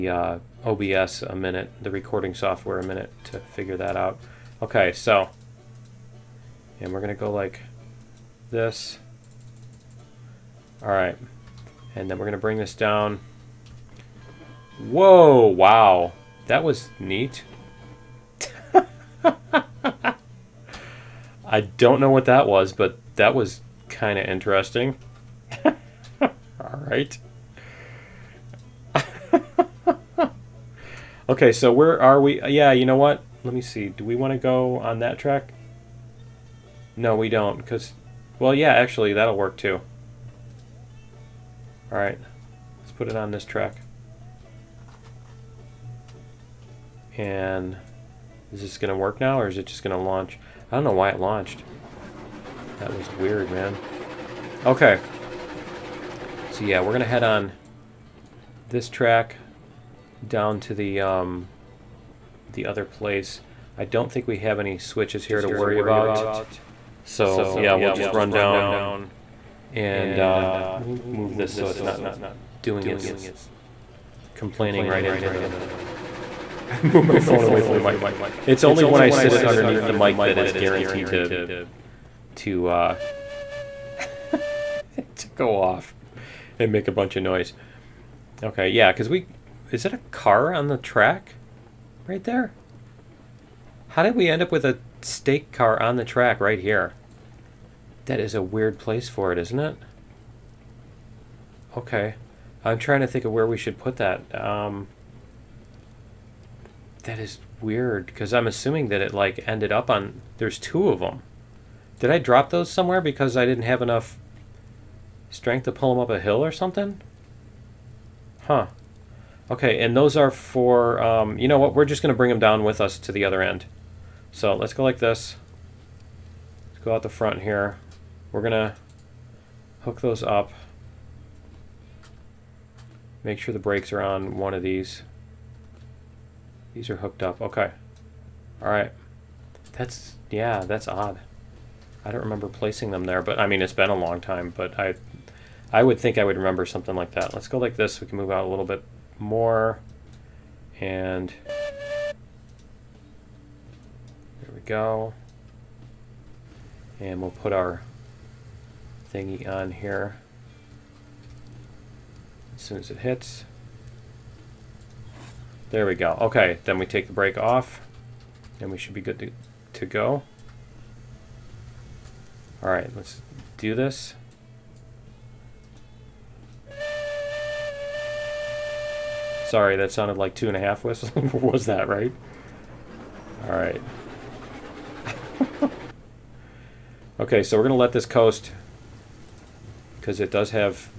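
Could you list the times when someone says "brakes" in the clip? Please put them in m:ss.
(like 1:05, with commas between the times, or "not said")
2:13, 2:47.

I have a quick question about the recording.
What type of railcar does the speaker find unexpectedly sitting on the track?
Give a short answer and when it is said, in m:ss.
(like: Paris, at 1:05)
stake car, at 1:35.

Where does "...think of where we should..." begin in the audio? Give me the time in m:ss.
1:43.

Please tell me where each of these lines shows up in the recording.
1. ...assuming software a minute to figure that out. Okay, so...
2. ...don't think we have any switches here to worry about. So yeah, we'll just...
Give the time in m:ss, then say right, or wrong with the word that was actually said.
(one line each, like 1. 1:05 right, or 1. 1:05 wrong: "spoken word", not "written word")
1. 0:01 wrong: "recording", not "assuming"
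2. 1:03 right.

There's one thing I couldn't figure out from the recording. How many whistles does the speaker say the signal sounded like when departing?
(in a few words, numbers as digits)
2 and a half.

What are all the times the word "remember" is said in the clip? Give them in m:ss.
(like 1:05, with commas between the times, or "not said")
2:22, 2:26.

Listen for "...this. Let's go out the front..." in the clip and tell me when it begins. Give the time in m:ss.
2:04.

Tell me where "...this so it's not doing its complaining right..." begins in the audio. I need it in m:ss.
1:11.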